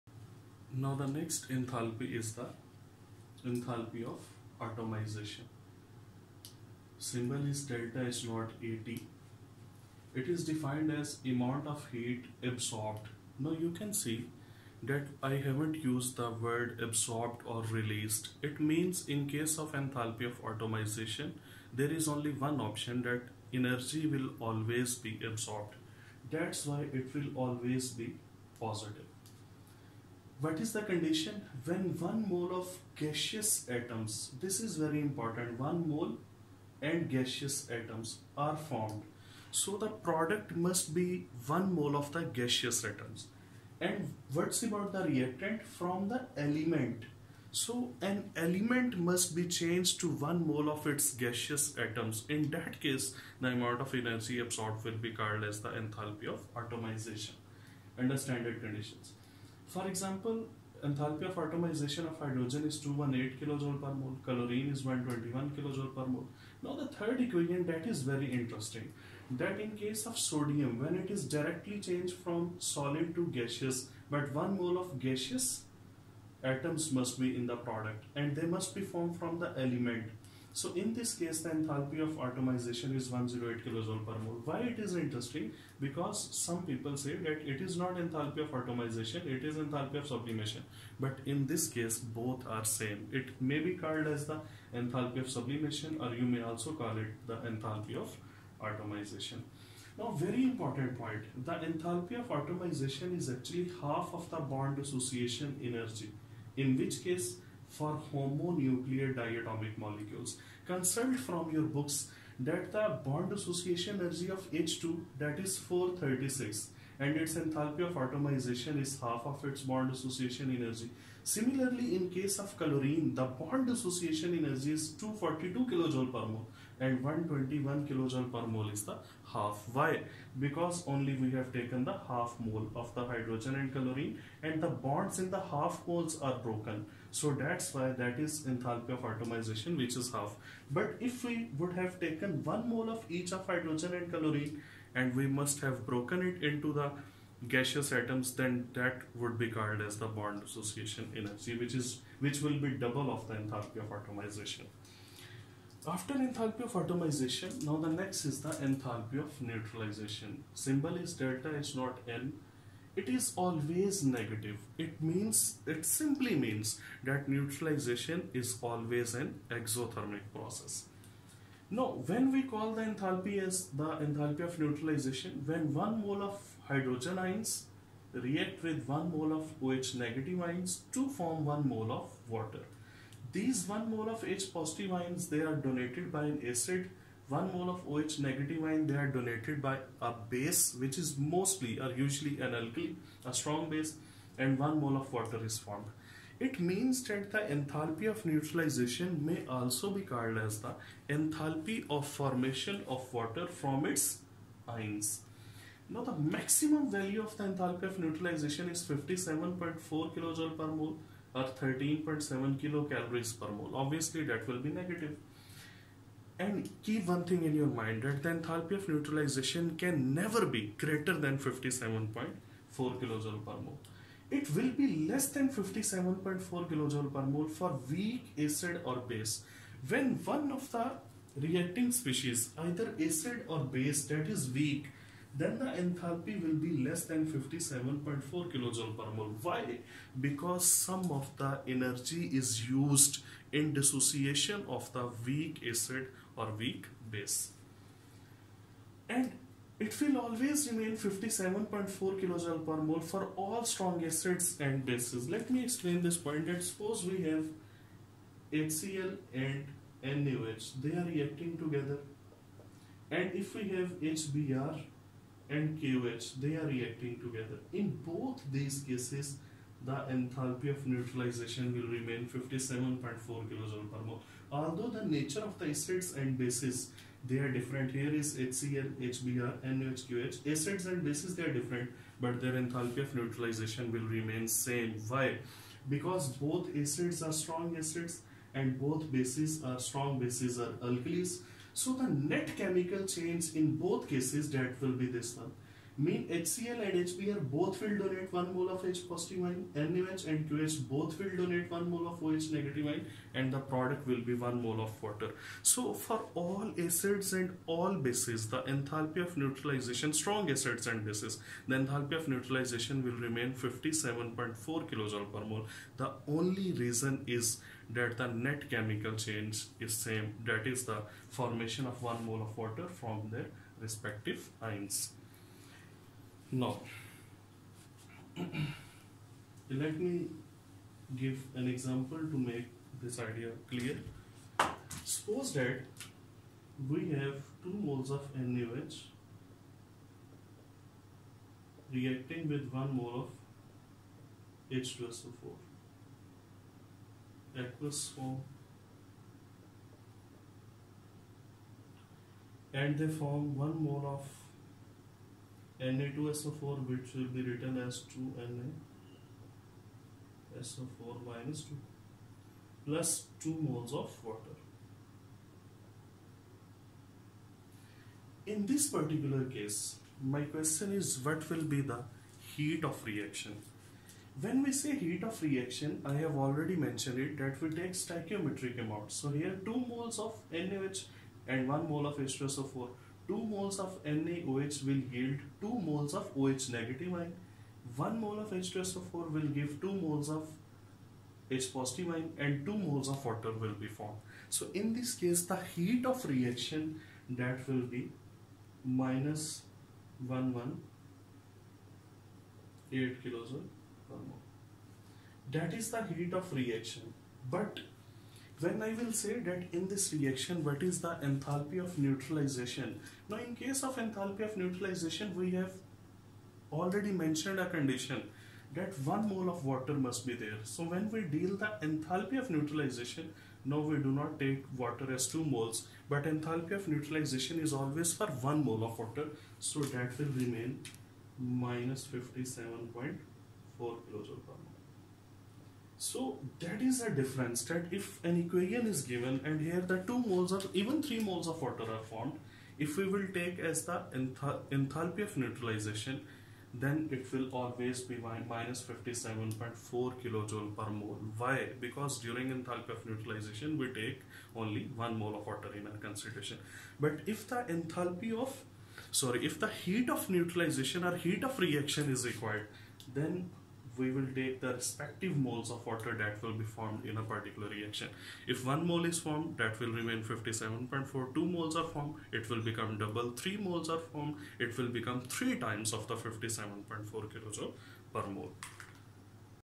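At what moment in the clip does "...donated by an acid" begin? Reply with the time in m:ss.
3:05.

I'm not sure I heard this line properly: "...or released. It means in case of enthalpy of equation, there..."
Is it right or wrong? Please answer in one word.
wrong.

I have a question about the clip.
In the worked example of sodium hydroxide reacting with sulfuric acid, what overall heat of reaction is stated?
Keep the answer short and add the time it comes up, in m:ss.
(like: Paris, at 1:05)
-118 kJ, at 6:39.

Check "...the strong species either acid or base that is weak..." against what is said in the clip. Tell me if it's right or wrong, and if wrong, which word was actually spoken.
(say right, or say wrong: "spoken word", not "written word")
wrong: "reacting", not "strong".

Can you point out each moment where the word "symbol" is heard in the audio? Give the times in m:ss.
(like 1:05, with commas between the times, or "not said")
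0:06, 2:40.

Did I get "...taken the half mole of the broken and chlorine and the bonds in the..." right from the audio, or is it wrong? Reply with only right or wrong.
wrong.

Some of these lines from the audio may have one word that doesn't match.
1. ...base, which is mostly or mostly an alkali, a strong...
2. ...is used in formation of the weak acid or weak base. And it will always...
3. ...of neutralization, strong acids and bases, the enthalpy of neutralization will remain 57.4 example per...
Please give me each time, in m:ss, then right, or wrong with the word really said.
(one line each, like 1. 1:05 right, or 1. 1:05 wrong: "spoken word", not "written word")
1. 3:10 wrong: "usually", not "mostly"
2. 4:02 wrong: "dissociation", not "formation"
3. 5:09 wrong: "kilojoule", not "example".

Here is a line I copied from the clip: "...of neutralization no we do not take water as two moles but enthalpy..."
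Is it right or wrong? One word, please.
right.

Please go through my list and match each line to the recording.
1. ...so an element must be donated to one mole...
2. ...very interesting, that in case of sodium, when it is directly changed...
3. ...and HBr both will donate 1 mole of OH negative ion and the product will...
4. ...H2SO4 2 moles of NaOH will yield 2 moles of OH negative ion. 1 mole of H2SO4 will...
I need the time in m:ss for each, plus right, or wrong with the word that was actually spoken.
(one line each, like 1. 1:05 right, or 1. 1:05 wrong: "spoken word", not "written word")
1. 0:47 wrong: "changed", not "donated"
2. 1:08 right
3. 5:00 wrong: "KOH", not "HBr"
4. 6:22 right.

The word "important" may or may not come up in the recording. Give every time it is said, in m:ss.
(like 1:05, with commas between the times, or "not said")
0:35, 1:40.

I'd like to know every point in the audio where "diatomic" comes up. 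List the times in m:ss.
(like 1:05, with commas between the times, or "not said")
1:49.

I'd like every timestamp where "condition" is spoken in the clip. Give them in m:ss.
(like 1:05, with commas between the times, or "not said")
0:30, 0:58, 6:57.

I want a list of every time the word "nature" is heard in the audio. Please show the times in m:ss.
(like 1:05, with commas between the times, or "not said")
4:35.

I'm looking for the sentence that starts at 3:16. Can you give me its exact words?
it means that the enthalpy of neutralization may also be called as the enthalpy of formation of water from its ions.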